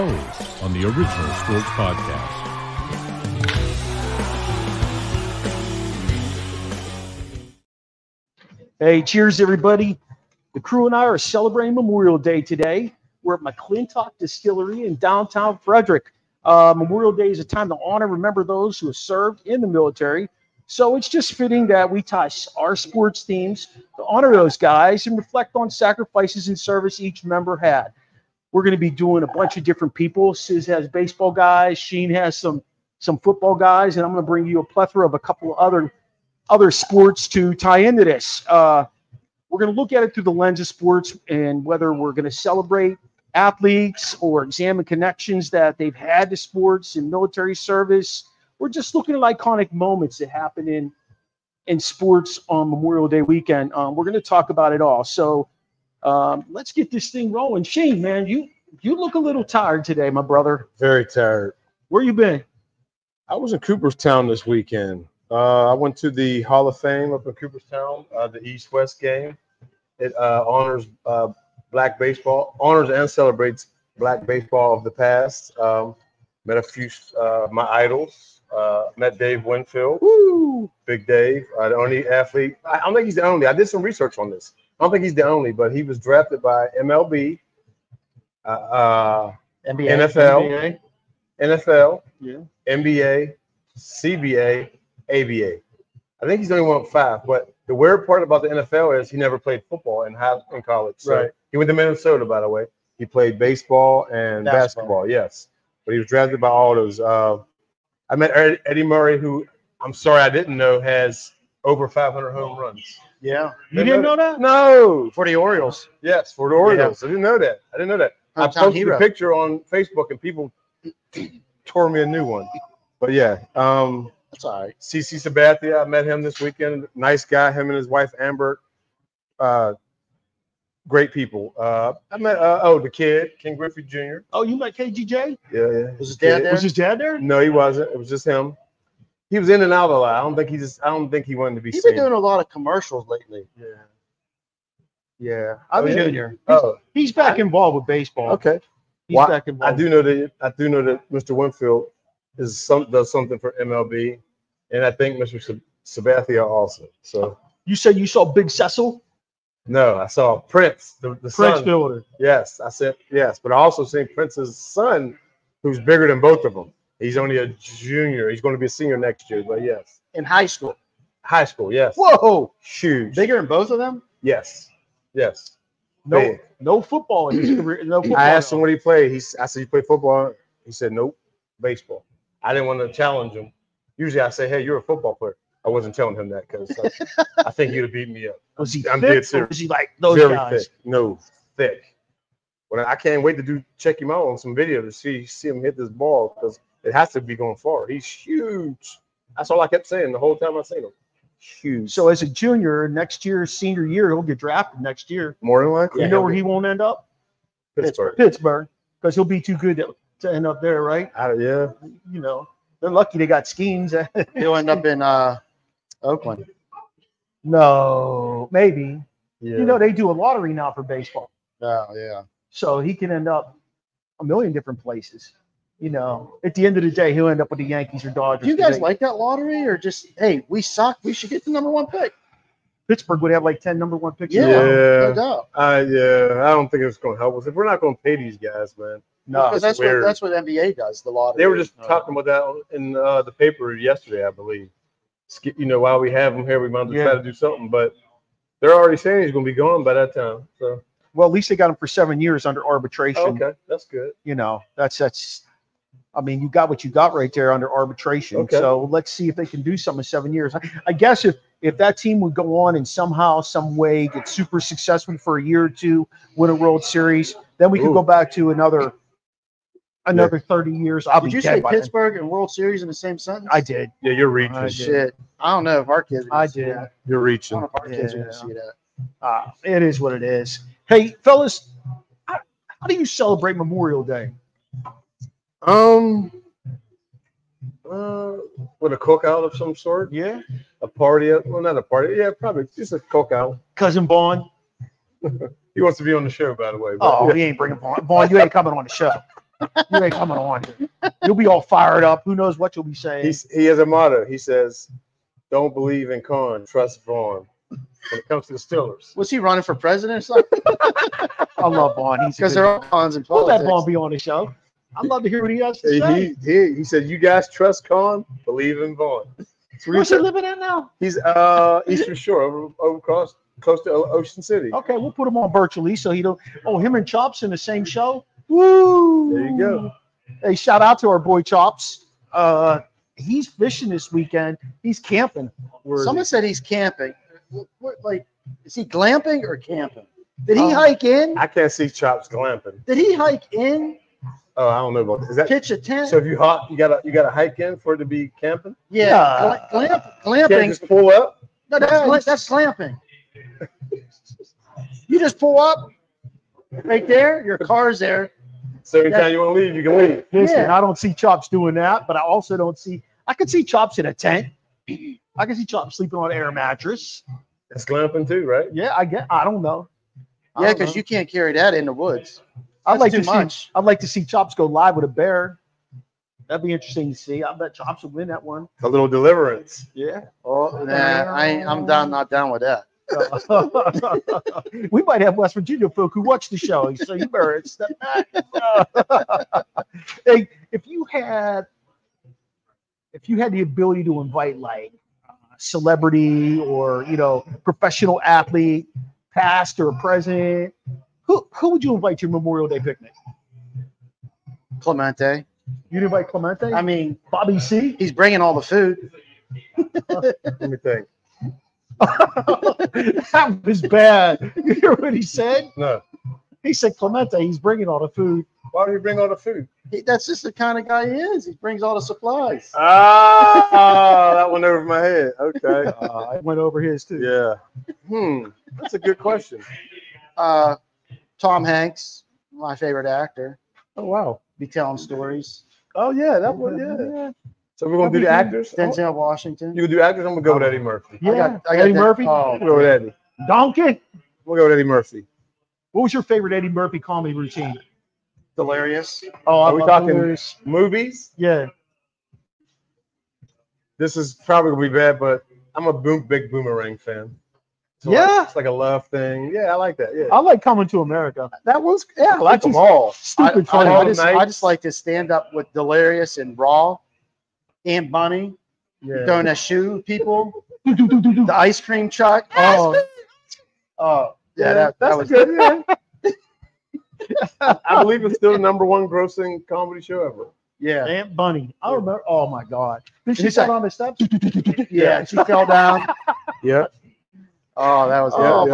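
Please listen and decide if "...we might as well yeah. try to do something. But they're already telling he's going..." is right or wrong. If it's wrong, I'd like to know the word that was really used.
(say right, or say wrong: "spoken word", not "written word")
wrong: "saying", not "telling".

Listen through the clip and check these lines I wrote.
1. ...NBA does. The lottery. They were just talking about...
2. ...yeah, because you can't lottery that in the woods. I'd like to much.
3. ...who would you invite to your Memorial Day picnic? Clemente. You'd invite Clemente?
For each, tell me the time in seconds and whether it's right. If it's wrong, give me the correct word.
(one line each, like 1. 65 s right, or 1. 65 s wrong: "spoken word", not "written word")
1. 240 s right
2. 370 s wrong: "carry", not "lottery"
3. 401 s right.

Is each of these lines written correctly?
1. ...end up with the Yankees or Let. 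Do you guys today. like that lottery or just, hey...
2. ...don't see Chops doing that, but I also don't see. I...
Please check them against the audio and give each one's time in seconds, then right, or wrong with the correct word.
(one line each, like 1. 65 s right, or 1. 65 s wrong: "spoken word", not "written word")
1. 227 s wrong: "Dodgers", not "Let"
2. 360 s right.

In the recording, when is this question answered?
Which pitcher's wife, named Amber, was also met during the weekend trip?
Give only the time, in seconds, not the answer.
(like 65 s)
124 s.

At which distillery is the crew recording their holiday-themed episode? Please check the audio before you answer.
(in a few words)
McClintock Distillery.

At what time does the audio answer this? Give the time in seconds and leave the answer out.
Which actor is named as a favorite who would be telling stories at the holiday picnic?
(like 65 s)
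431 s.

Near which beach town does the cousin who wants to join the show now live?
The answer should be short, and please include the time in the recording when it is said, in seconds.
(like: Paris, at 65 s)
Ocean City, at 323 s.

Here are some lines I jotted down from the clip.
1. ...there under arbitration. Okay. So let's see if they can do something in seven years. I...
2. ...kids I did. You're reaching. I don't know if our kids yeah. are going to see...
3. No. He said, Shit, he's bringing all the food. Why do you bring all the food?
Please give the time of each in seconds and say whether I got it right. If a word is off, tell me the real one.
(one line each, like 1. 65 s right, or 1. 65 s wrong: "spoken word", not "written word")
1. 257 s right
2. 276 s right
3. 415 s wrong: "Clemente", not "Shit".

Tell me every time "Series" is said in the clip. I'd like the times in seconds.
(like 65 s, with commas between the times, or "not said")
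266 s, 272 s.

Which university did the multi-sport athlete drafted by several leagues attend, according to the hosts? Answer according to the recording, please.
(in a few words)
Minnesota.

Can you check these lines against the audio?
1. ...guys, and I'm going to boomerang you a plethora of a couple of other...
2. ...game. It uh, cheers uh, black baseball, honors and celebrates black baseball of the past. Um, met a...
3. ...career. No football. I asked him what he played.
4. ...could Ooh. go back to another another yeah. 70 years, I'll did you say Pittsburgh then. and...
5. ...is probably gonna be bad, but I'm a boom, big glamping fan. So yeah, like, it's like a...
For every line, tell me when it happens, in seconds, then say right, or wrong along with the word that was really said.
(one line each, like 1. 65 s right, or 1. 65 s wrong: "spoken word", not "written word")
1. 33 s wrong: "bring", not "boomerang"
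2. 69 s wrong: "honors", not "cheers"
3. 177 s right
4. 267 s wrong: "30", not "70"
5. 454 s wrong: "boomerang", not "glamping".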